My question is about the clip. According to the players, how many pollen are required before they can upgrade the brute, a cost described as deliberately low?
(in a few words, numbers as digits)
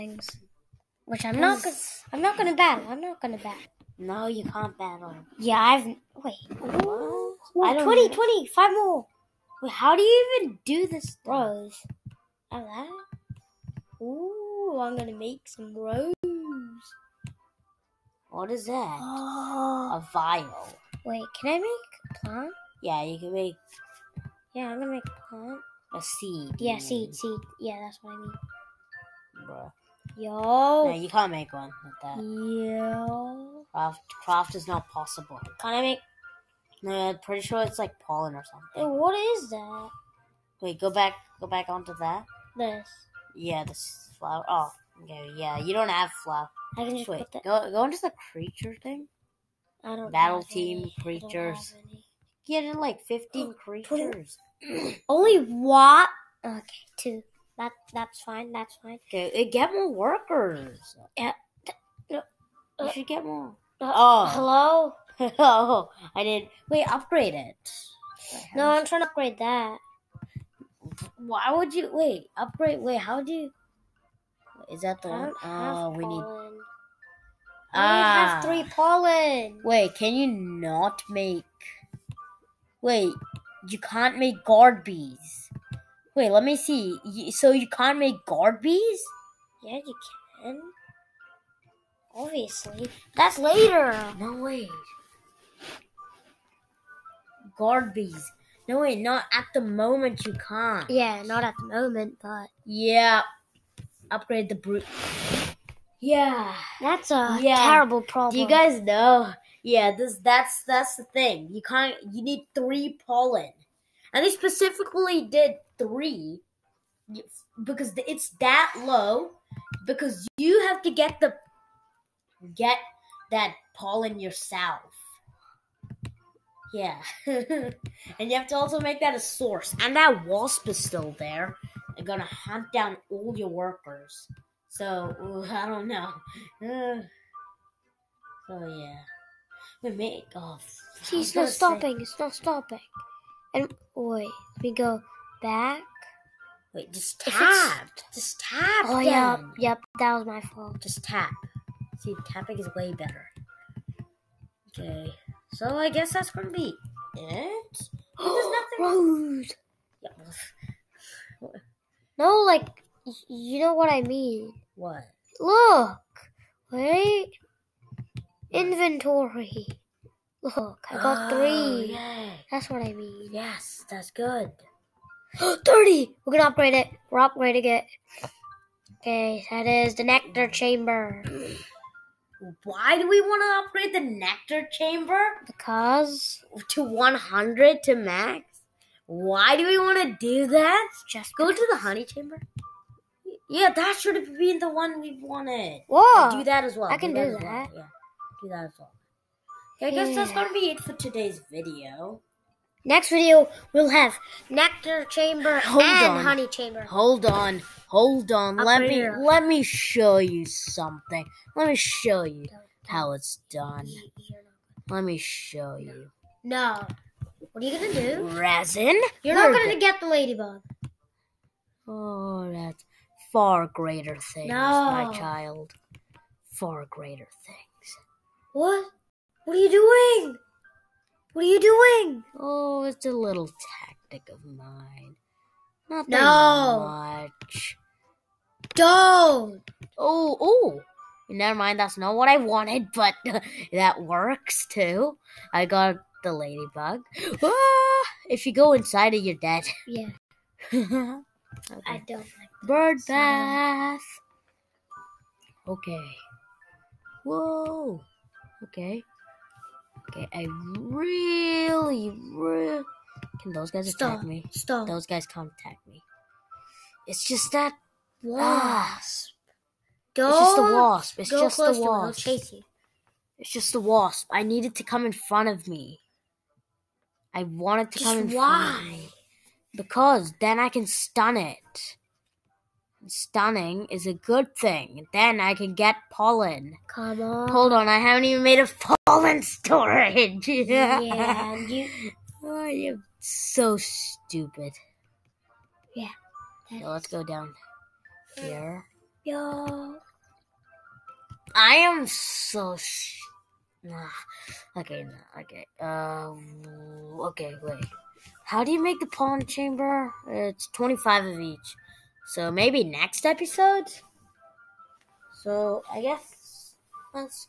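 3.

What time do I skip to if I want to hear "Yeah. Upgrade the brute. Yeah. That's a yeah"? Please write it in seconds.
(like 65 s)
102 s.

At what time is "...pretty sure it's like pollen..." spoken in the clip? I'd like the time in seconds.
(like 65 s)
37 s.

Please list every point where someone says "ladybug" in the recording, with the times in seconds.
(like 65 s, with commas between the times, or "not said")
220 s, 246 s.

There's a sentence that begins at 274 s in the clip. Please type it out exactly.
I needed to come in front of me.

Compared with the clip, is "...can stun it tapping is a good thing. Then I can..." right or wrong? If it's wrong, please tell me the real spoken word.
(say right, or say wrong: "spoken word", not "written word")
wrong: "stunning", not "tapping".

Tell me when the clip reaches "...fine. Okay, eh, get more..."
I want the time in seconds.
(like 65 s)
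58 s.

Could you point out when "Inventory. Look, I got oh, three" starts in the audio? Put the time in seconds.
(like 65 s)
168 s.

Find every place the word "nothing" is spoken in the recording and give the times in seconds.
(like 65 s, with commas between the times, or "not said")
158 s, 235 s.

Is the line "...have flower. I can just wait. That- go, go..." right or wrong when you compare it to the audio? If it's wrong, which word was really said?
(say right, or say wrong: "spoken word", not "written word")
right.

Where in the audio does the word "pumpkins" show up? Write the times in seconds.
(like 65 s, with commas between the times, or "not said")
not said.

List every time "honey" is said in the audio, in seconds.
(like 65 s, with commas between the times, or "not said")
191 s, 206 s.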